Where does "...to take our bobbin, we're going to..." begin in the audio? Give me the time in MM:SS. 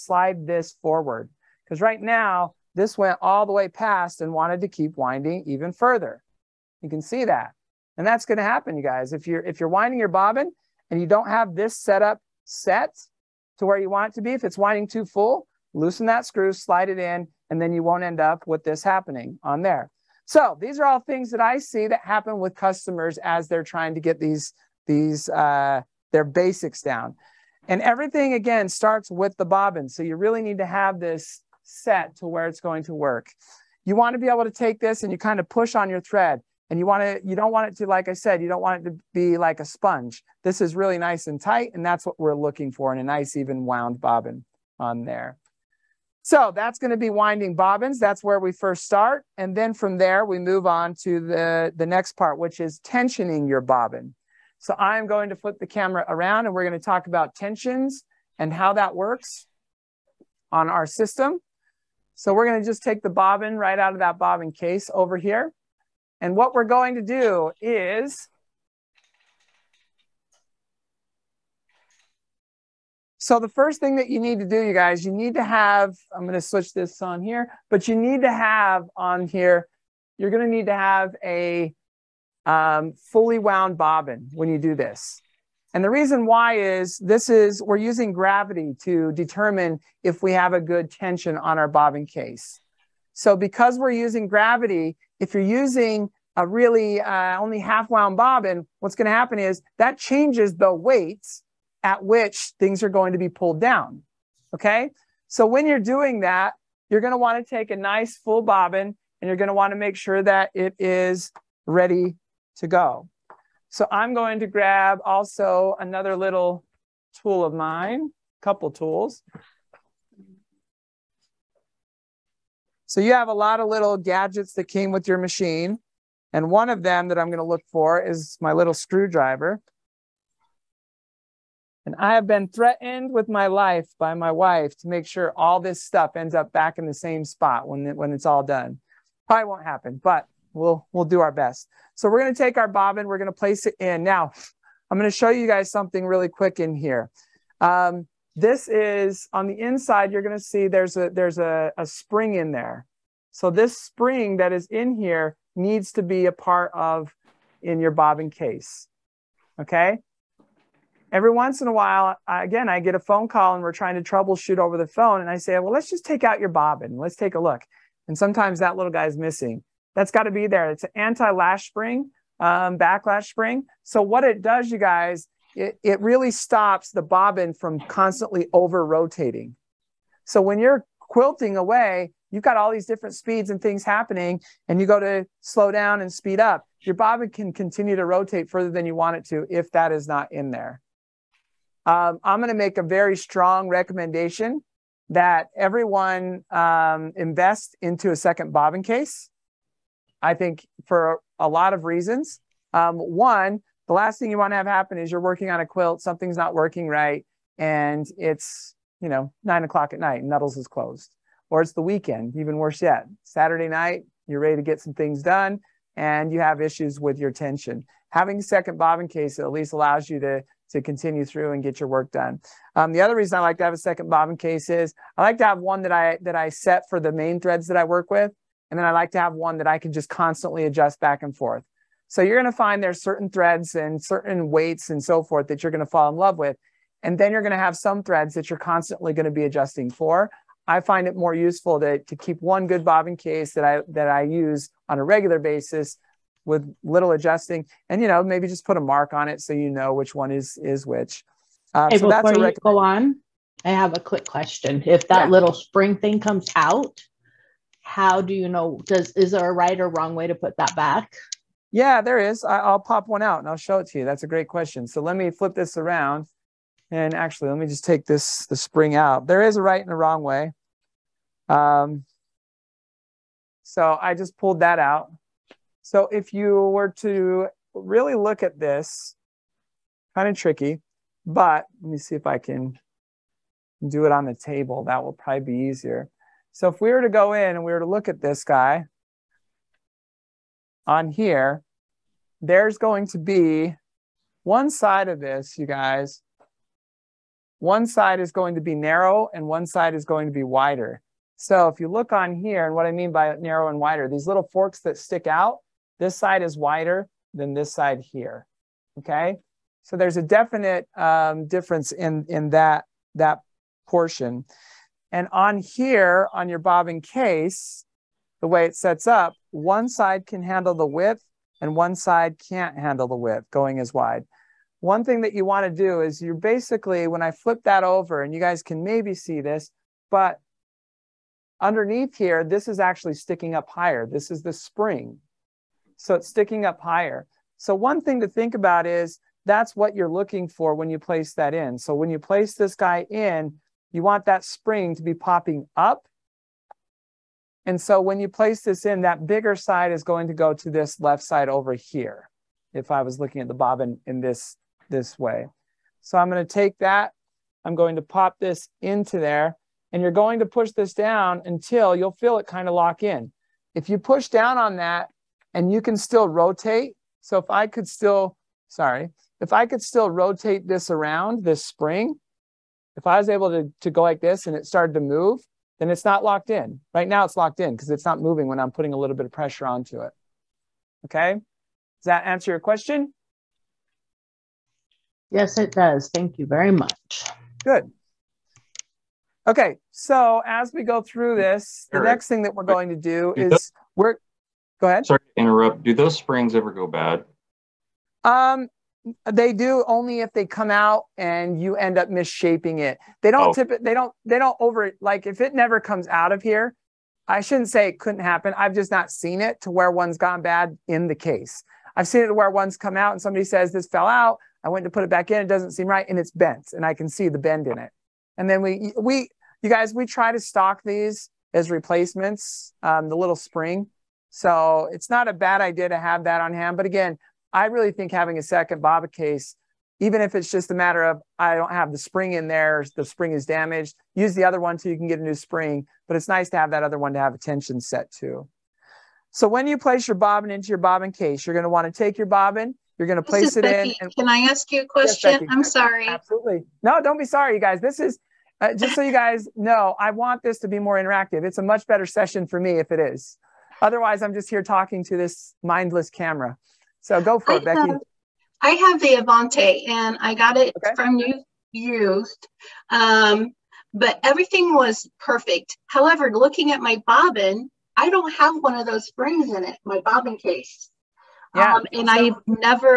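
02:22.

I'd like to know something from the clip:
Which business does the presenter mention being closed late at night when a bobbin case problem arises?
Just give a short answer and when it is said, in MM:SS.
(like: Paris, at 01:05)
Nuttall's, at 03:30.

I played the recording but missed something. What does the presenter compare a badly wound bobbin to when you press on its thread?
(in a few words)
A sponge.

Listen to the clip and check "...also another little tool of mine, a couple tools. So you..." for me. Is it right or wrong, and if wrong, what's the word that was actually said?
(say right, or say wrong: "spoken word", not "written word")
right.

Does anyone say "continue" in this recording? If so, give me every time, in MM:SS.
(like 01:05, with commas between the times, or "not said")
03:07, 03:40.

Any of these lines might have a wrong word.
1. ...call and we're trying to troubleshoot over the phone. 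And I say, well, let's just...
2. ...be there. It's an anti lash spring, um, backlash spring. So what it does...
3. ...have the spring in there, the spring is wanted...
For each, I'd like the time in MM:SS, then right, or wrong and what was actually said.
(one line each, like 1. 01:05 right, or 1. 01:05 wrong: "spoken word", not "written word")
1. 02:43 right
2. 02:50 right
3. 07:11 wrong: "damaged", not "wanted".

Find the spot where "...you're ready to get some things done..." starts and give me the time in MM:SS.
03:34.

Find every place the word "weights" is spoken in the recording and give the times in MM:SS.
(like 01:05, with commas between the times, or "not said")
01:40, 03:54.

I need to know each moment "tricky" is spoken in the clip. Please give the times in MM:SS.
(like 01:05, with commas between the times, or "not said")
04:40.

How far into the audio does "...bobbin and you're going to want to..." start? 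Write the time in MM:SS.
01:48.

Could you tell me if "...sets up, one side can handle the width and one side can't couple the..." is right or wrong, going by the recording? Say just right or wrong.
wrong.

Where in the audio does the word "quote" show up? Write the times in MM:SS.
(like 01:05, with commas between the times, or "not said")
not said.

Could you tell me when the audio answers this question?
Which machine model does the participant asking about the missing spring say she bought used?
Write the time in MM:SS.
07:39.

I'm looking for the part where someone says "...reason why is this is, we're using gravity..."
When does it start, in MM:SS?
01:25.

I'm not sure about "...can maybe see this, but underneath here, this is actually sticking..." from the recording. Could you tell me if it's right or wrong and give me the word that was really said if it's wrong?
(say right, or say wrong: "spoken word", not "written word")
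right.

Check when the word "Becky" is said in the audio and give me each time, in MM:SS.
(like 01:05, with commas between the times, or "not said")
07:23, 07:37.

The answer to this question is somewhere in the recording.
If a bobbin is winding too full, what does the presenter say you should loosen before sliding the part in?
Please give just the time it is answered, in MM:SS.
00:15.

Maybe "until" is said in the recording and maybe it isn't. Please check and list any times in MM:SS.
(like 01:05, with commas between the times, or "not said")
06:01.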